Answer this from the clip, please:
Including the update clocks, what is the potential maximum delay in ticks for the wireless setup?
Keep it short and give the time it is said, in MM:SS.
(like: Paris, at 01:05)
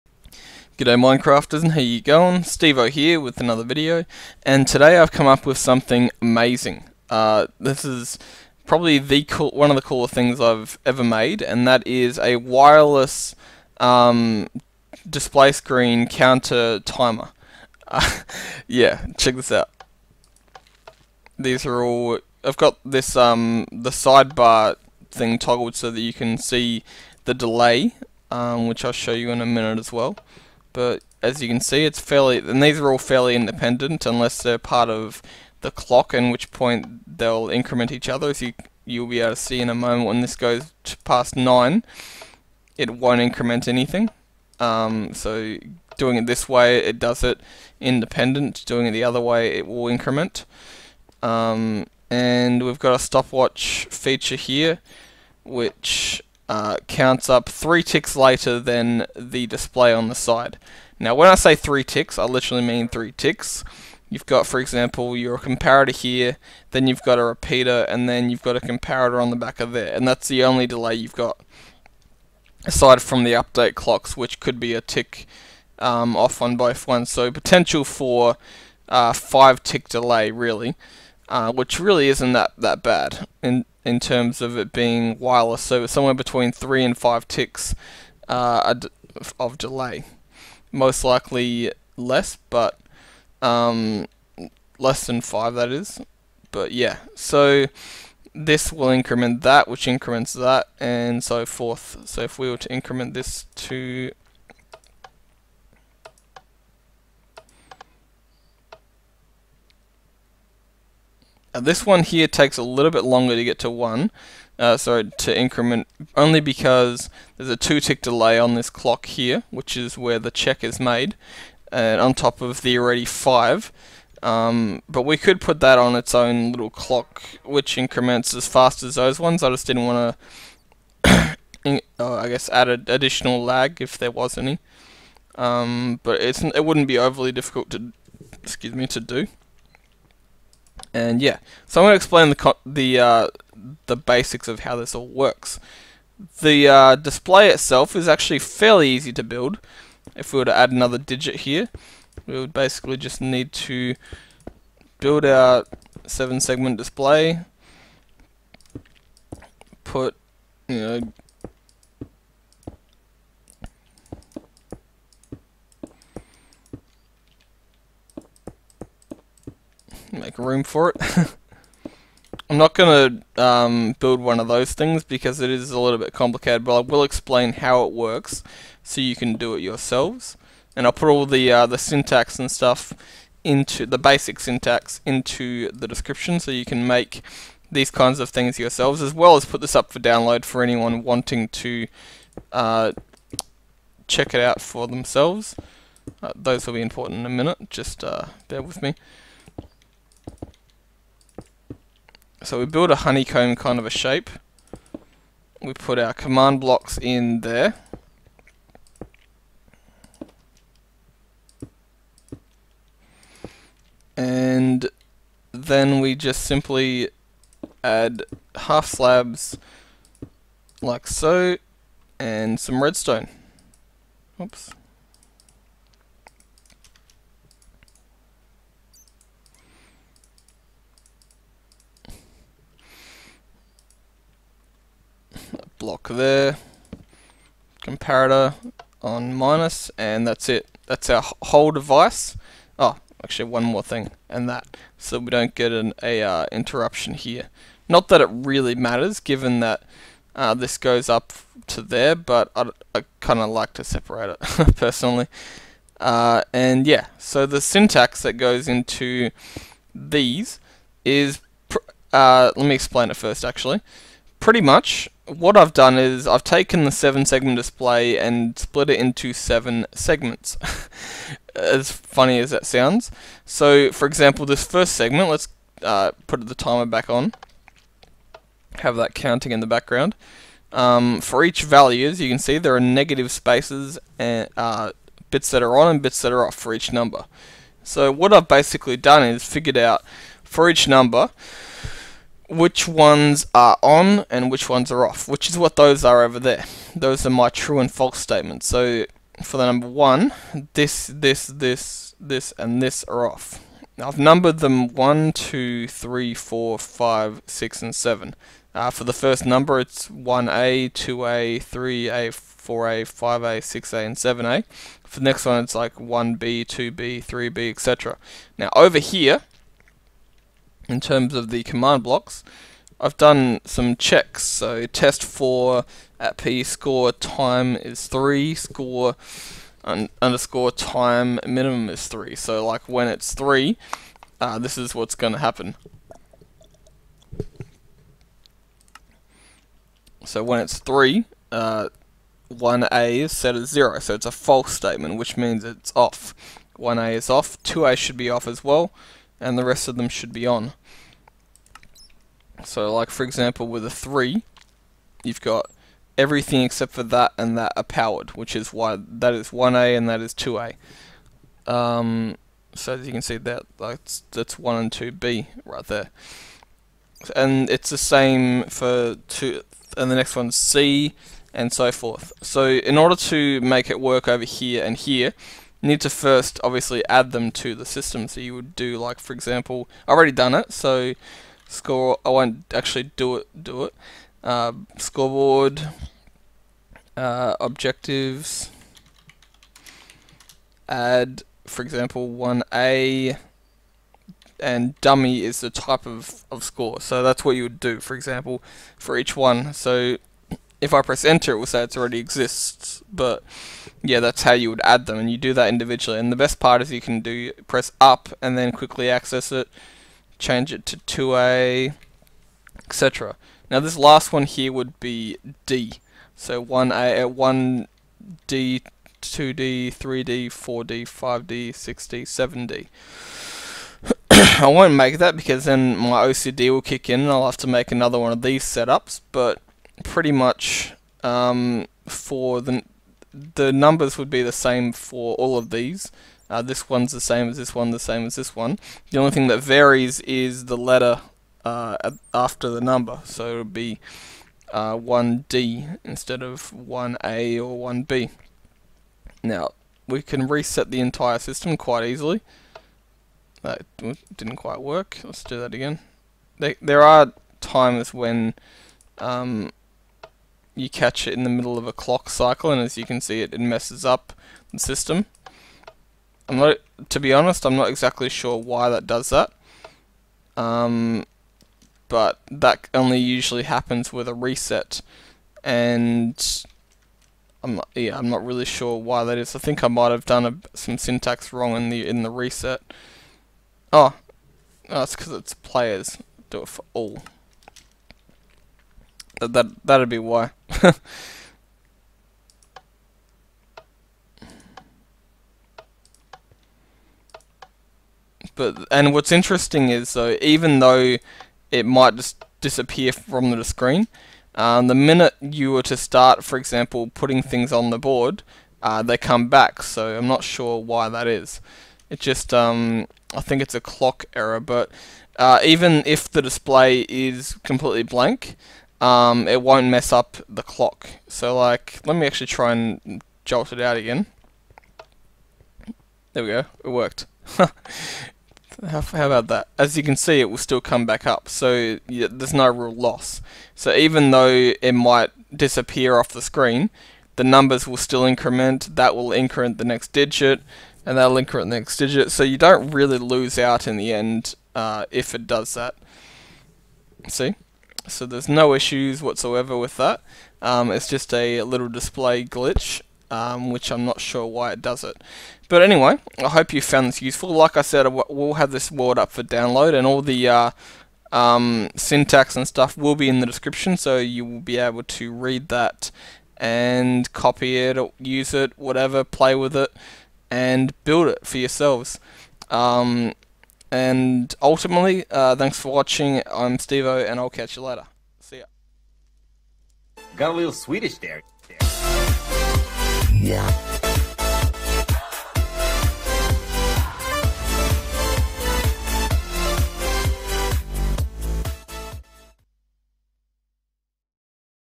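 5, at 01:19.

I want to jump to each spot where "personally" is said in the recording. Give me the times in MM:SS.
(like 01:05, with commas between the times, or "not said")
04:14.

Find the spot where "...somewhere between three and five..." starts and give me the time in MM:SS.
01:25.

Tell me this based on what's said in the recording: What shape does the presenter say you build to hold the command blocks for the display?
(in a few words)
Honeycomb.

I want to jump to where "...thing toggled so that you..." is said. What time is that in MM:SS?
00:25.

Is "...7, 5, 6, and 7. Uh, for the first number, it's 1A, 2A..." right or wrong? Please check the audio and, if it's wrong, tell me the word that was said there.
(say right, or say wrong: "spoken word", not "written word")
wrong: "4", not "7".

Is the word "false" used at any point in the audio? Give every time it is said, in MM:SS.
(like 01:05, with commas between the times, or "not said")
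04:57, 05:44.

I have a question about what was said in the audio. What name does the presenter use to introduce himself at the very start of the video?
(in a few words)
Steve-O.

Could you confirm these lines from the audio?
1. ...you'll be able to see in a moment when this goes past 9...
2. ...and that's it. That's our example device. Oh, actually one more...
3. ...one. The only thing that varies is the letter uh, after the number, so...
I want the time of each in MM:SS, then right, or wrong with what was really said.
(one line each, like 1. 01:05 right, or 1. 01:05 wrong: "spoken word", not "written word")
1. 00:38 right
2. 03:59 wrong: "whole", not "example"
3. 07:18 right.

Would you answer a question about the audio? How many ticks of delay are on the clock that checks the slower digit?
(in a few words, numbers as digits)
2.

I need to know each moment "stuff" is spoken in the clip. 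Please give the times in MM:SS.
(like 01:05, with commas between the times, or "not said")
03:02, 09:22.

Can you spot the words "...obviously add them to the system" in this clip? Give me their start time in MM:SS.
06:16.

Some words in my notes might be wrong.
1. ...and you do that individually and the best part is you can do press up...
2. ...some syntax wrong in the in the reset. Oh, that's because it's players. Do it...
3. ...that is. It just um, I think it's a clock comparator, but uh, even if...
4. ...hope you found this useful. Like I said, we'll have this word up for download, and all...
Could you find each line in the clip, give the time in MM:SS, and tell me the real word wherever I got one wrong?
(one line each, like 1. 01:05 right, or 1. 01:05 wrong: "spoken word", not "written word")
1. 06:45 right
2. 08:00 right
3. 08:31 wrong: "error", not "comparator"
4. 09:16 right.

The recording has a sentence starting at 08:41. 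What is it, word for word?
So like, let me actually try and jolt it out again.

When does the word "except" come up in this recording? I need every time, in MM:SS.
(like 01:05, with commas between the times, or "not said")
05:56.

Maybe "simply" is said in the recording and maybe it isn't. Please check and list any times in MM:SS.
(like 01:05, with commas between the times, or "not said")
03:36.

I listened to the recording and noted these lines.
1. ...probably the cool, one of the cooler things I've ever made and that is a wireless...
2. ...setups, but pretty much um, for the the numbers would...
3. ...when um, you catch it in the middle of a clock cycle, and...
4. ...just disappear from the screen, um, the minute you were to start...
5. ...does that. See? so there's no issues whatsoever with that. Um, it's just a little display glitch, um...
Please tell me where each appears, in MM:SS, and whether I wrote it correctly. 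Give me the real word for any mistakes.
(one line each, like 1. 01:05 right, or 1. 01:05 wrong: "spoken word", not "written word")
1. 00:08 right
2. 07:08 right
3. 07:38 right
4. 08:22 right
5. 09:05 right.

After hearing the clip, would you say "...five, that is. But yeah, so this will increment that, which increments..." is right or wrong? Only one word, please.
right.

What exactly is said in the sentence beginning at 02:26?
The uh, display itself is actually fairly easy to build.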